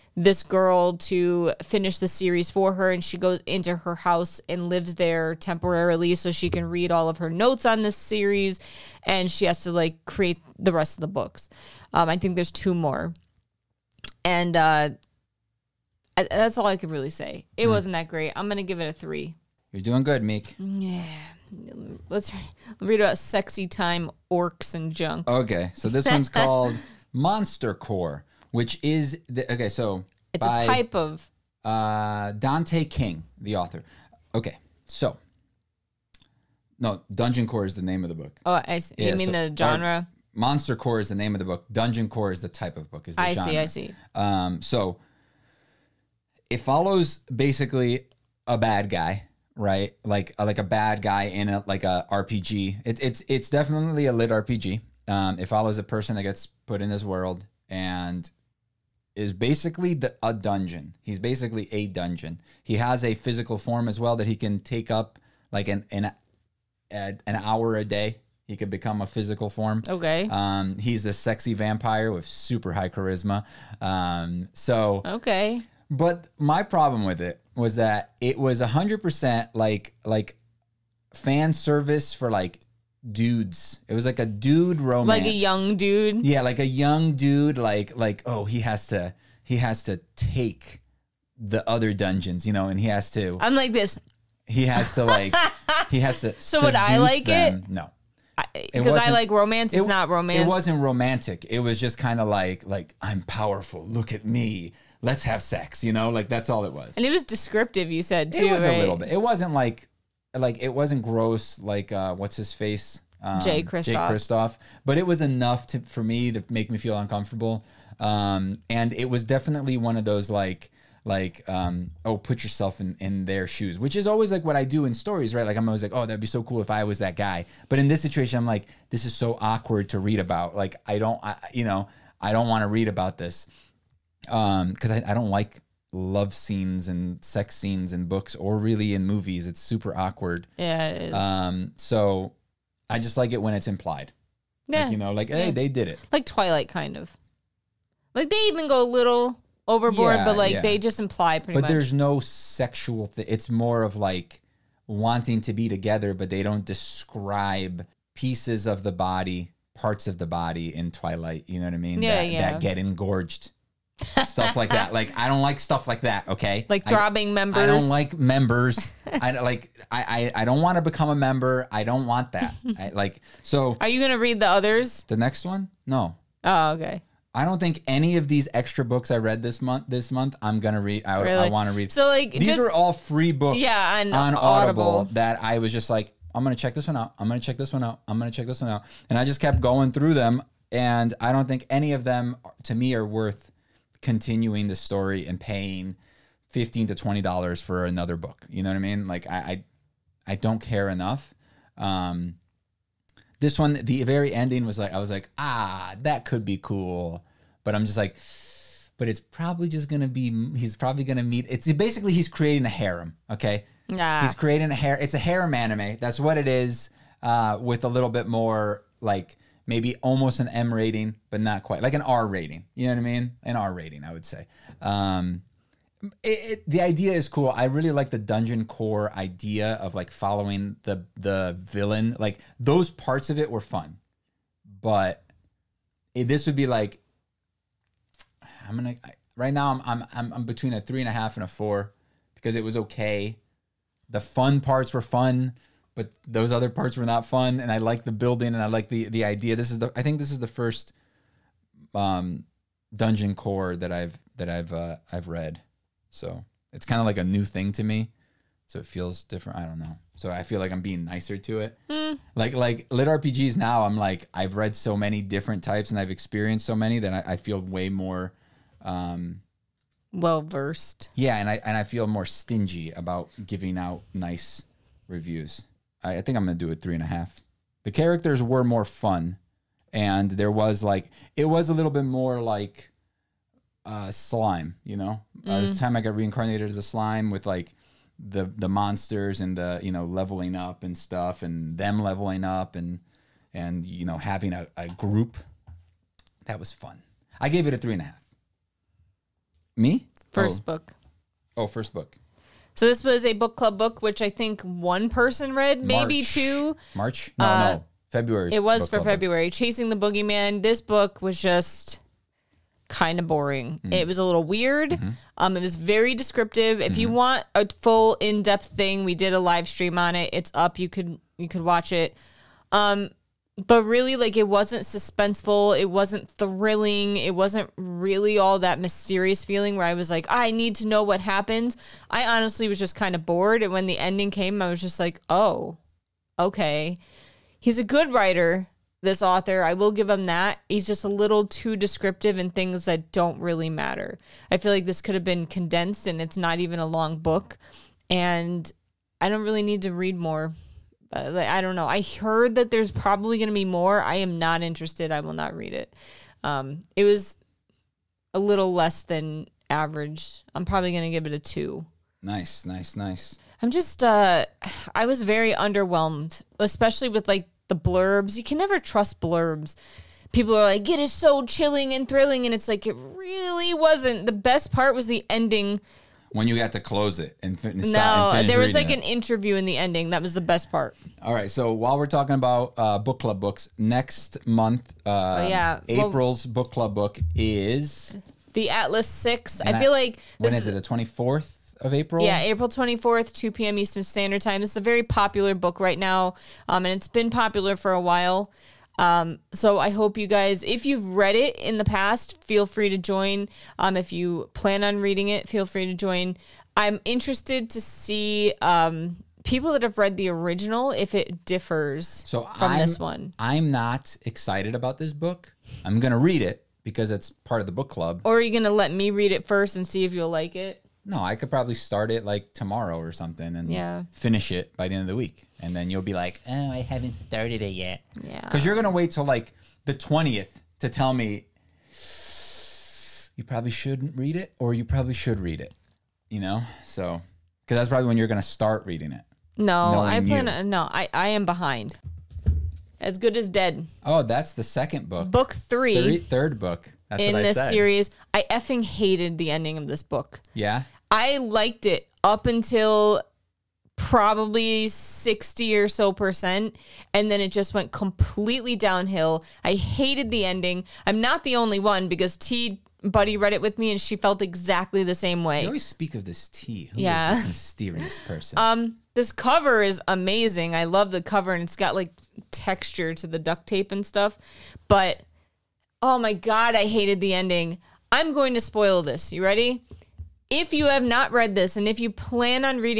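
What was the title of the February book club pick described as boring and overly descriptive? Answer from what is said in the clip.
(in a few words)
Chasing the Boogeyman.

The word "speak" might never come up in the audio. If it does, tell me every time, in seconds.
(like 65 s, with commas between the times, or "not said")
465 s.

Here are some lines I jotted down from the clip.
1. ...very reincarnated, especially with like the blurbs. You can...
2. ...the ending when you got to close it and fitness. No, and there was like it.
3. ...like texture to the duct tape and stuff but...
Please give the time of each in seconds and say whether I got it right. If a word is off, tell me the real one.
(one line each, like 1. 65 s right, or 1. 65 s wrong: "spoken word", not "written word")
1. 365 s wrong: "underwhelmed", not "reincarnated"
2. 375 s right
3. 471 s right.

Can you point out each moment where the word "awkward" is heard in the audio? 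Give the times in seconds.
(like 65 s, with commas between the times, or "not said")
129 s, 139 s.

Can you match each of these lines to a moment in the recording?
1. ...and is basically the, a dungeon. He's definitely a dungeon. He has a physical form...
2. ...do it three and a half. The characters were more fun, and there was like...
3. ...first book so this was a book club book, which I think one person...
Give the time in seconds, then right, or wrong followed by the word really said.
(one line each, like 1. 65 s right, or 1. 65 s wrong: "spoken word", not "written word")
1. 57 s wrong: "basically", not "definitely"
2. 276 s right
3. 301 s right.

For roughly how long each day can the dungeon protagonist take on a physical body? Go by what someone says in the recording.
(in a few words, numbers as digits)
an hour.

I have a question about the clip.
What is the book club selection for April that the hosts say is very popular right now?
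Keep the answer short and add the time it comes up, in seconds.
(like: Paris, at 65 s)
The Atlas Six, at 388 s.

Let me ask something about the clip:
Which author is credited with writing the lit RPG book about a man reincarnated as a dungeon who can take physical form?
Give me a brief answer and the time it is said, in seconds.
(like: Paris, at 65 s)
Dante King, at 32 s.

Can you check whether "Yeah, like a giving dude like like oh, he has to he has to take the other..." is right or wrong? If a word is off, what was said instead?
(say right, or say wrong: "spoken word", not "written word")
wrong: "young", not "giving".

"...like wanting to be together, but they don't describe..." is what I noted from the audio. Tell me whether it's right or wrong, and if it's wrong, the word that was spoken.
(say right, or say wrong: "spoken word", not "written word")
right.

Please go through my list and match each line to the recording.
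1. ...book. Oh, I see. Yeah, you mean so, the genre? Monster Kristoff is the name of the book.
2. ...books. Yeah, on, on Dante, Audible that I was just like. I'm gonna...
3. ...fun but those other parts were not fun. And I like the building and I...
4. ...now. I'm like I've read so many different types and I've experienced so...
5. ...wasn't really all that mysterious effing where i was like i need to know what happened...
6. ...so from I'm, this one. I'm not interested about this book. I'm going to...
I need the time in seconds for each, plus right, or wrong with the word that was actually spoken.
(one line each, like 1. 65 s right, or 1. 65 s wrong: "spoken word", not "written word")
1. 38 s wrong: "Core", not "Kristoff"
2. 183 s wrong: "Audible", not "Dante"
3. 245 s right
4. 263 s right
5. 327 s wrong: "feeling", not "effing"
6. 412 s wrong: "excited", not "interested".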